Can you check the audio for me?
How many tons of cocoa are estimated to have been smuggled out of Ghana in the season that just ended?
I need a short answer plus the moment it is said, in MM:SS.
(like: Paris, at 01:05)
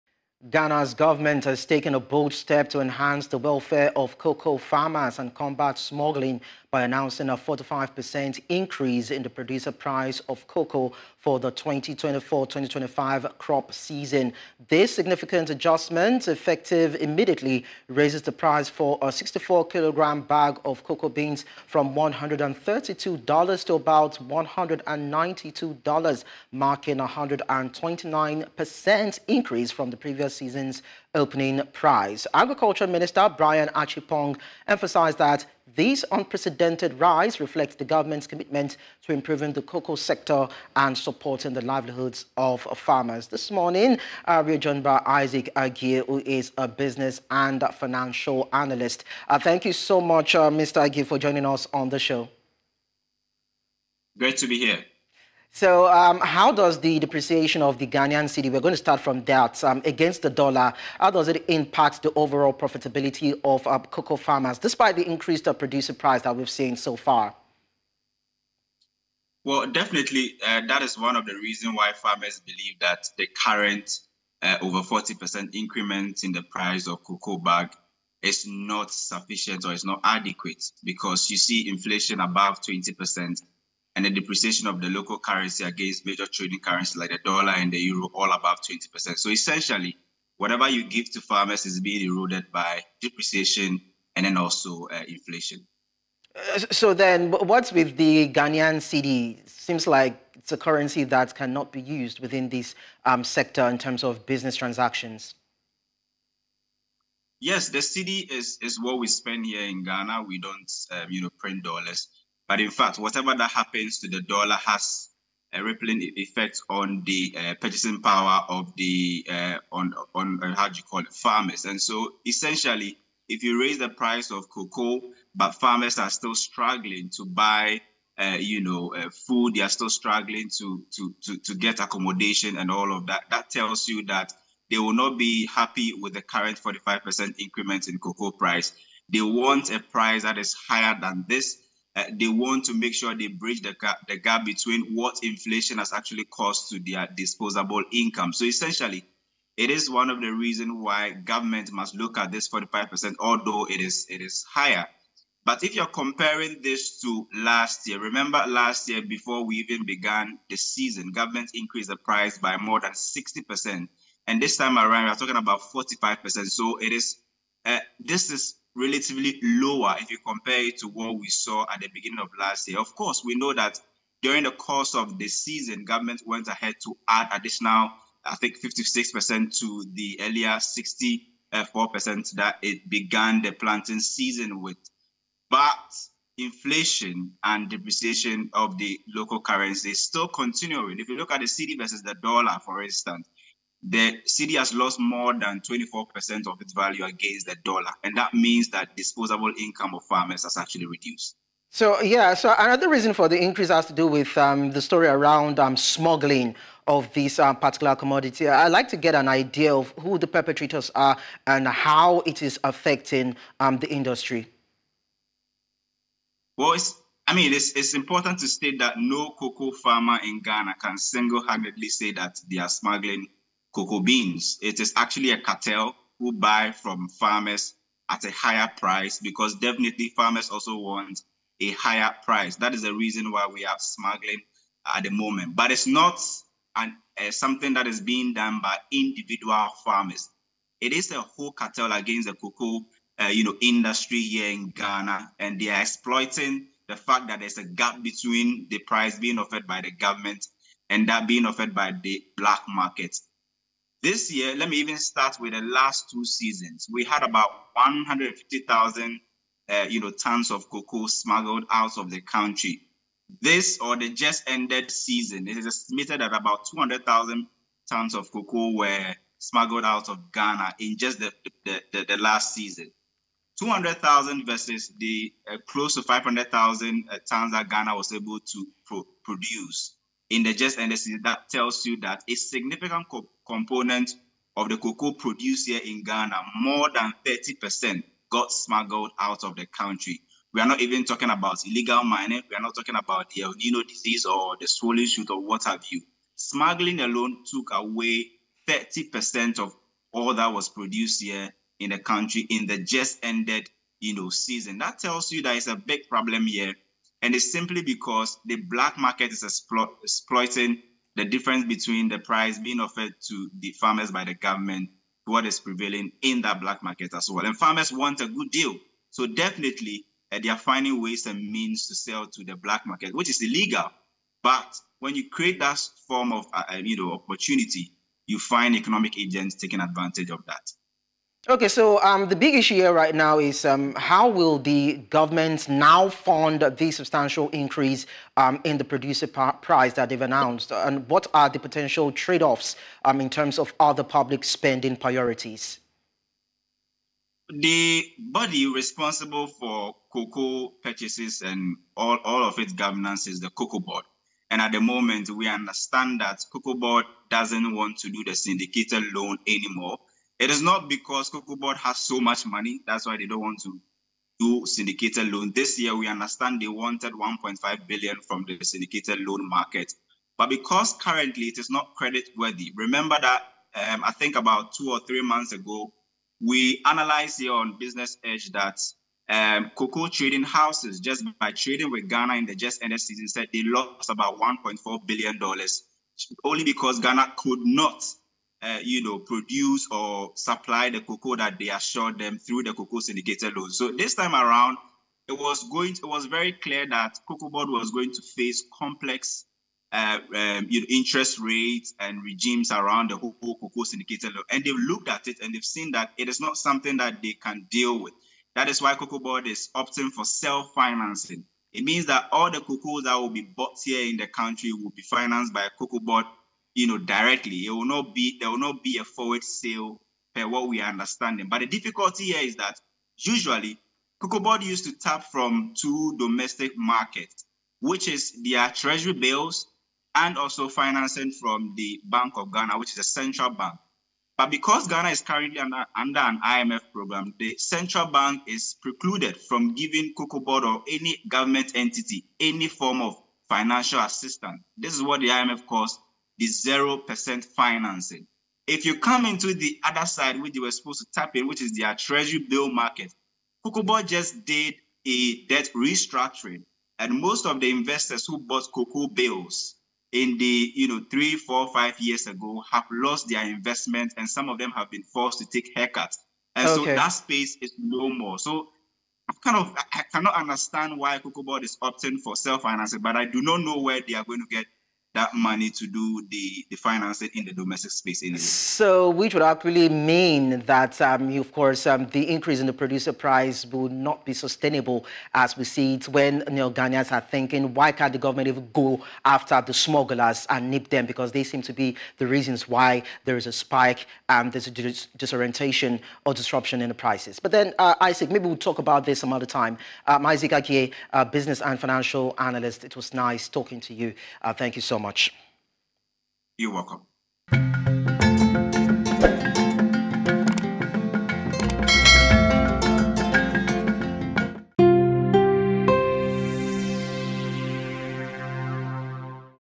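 200,000 tons, at 04:26.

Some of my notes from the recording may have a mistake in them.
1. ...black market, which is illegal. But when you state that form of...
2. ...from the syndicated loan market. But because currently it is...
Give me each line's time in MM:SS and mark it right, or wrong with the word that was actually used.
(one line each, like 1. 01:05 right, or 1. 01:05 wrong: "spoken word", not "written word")
1. 05:22 wrong: "create", not "state"
2. 06:08 right.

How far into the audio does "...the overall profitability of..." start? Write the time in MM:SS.
01:02.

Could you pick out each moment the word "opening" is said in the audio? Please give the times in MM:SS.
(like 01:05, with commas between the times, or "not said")
00:31.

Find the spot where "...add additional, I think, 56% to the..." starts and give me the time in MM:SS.
02:57.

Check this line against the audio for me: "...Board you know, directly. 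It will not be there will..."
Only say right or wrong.
right.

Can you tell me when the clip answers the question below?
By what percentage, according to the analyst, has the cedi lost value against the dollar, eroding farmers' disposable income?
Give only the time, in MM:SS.
03:15.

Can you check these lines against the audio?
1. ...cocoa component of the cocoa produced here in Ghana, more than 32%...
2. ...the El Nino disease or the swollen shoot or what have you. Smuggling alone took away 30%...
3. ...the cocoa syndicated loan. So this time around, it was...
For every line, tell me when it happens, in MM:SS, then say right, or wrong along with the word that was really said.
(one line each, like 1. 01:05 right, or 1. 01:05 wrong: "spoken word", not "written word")
1. 04:43 wrong: "30", not "32"
2. 04:53 right
3. 06:32 right.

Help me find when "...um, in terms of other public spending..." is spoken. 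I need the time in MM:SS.
05:43.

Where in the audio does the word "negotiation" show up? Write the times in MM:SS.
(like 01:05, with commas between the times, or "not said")
not said.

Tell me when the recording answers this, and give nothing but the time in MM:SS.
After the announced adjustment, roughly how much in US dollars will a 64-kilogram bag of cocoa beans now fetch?
00:23.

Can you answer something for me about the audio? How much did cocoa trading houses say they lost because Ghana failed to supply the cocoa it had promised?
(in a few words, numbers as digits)
$1.4 billion.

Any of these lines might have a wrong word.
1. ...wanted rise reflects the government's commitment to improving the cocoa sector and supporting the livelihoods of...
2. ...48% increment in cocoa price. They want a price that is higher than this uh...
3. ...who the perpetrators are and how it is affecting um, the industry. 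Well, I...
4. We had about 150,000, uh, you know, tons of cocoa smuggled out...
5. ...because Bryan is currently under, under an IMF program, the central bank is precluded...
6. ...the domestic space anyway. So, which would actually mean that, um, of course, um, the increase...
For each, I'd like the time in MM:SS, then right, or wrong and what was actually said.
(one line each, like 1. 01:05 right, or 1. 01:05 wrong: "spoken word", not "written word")
1. 00:36 wrong: "unprecedented", not "wanted"
2. 02:16 wrong: "45", not "48"
3. 03:29 right
4. 04:16 right
5. 07:14 wrong: "Ghana", not "Bryan"
6. 07:57 right.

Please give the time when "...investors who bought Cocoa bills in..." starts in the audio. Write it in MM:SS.
07:37.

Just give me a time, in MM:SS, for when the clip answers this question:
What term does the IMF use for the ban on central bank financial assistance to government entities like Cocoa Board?
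07:26.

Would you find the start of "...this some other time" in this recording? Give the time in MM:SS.
08:19.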